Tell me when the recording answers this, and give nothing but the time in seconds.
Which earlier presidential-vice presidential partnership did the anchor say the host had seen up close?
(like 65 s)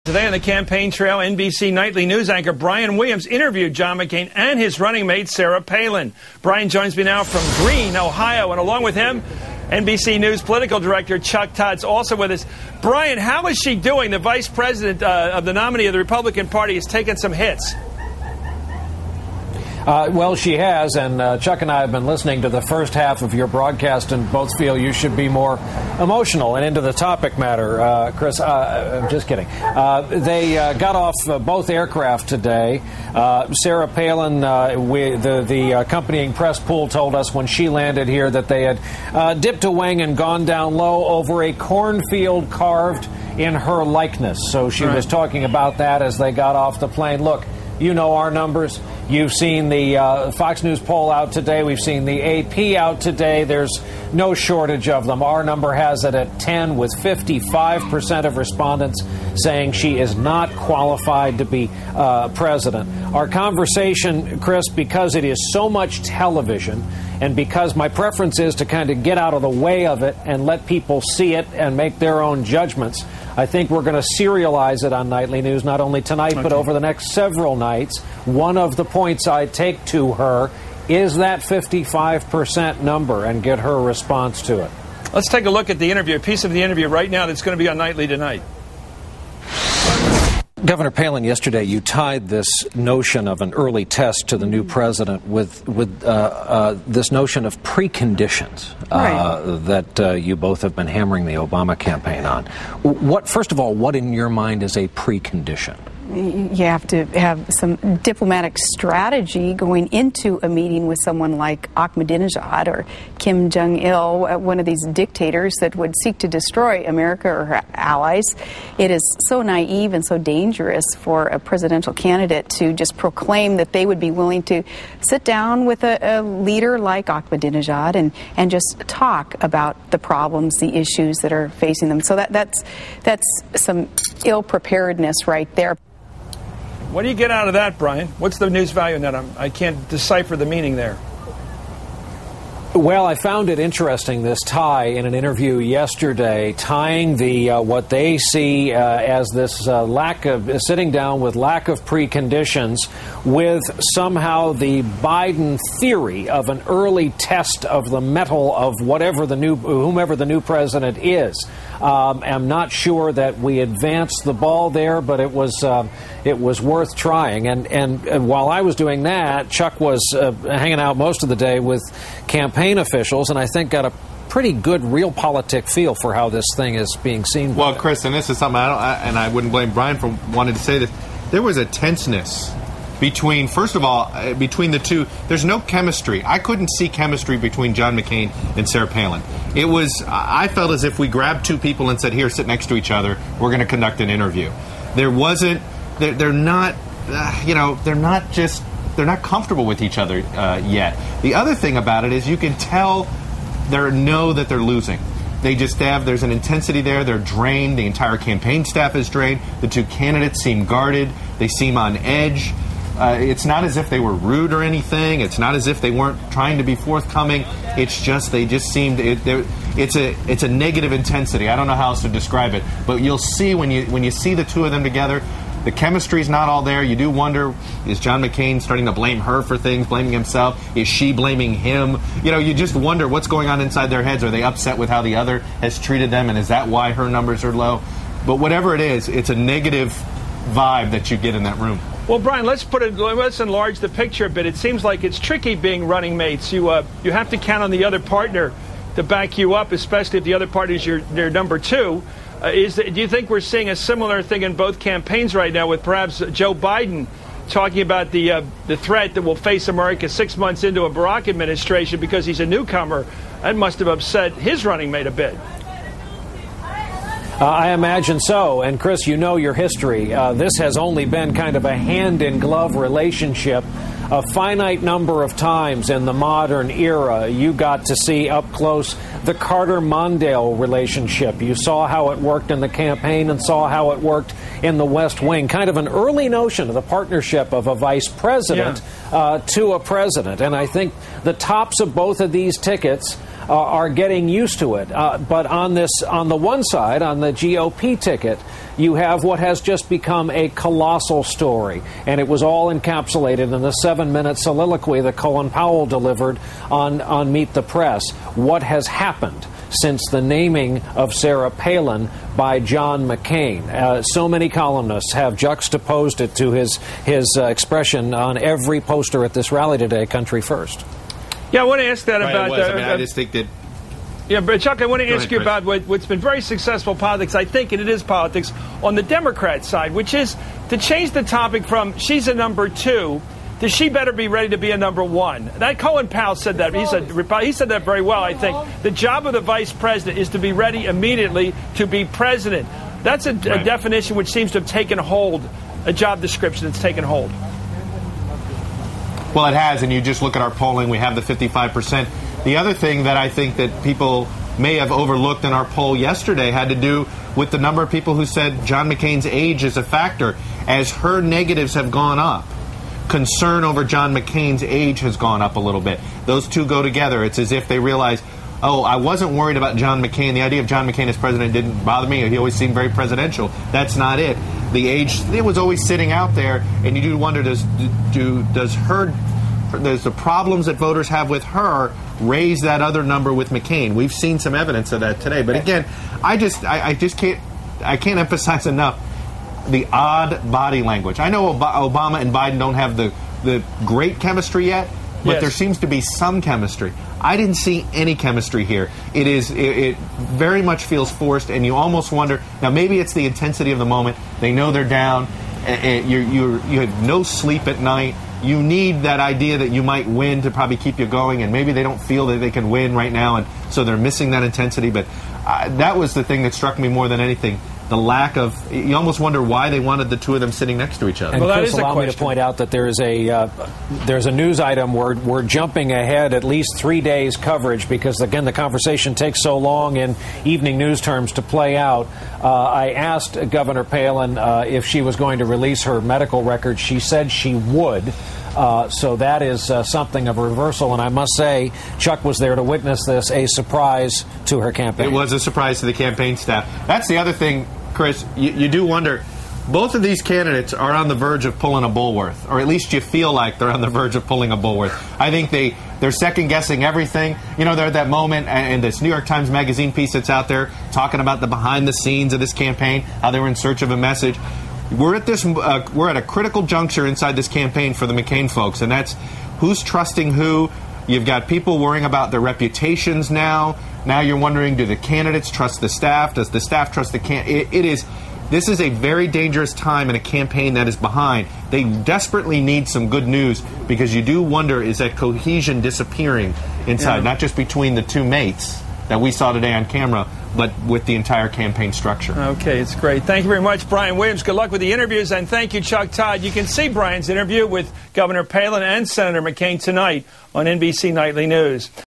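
279 s.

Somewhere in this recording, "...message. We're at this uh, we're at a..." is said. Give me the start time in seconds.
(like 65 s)
463 s.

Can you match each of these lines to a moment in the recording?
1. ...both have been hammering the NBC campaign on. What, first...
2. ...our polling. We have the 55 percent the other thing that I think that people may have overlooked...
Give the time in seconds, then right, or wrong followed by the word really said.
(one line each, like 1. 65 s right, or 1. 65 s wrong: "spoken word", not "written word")
1. 100 s wrong: "Obama", not "NBC"
2. 350 s right.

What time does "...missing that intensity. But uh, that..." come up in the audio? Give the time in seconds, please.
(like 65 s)
413 s.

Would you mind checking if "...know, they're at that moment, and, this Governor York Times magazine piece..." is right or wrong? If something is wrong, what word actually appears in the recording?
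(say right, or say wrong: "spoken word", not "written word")
wrong: "New", not "Governor".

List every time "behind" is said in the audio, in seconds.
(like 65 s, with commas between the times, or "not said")
461 s, 480 s.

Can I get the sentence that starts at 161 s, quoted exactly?
Um, I'm not sure that we advanced the ball there, but it was uh, it was worth trying.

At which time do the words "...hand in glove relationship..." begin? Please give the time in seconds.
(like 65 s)
271 s.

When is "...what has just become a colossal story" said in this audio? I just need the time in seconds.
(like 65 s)
299 s.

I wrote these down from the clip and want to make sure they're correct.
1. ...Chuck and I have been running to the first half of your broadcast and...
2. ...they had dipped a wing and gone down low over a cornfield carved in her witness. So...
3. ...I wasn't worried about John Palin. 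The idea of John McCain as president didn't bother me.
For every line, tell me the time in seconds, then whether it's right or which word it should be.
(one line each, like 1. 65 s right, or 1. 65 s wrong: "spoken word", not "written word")
1. 21 s wrong: "listening", not "running"
2. 38 s wrong: "likeness", not "witness"
3. 368 s wrong: "McCain", not "Palin".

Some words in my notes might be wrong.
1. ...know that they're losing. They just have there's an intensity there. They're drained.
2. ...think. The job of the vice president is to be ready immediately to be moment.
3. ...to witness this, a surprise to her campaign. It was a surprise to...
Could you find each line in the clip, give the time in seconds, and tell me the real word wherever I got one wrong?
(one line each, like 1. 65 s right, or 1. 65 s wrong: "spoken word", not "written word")
1. 203 s right
2. 338 s wrong: "president", not "moment"
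3. 442 s right.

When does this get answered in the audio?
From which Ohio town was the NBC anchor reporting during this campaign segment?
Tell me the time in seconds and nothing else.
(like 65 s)
7 s.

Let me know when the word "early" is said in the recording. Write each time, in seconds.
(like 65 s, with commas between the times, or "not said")
93 s, 156 s, 285 s.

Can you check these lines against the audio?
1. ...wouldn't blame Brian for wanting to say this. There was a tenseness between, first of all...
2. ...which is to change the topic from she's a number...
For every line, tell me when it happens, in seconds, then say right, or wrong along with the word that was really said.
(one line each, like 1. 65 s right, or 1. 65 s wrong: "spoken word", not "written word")
1. 179 s right
2. 329 s right.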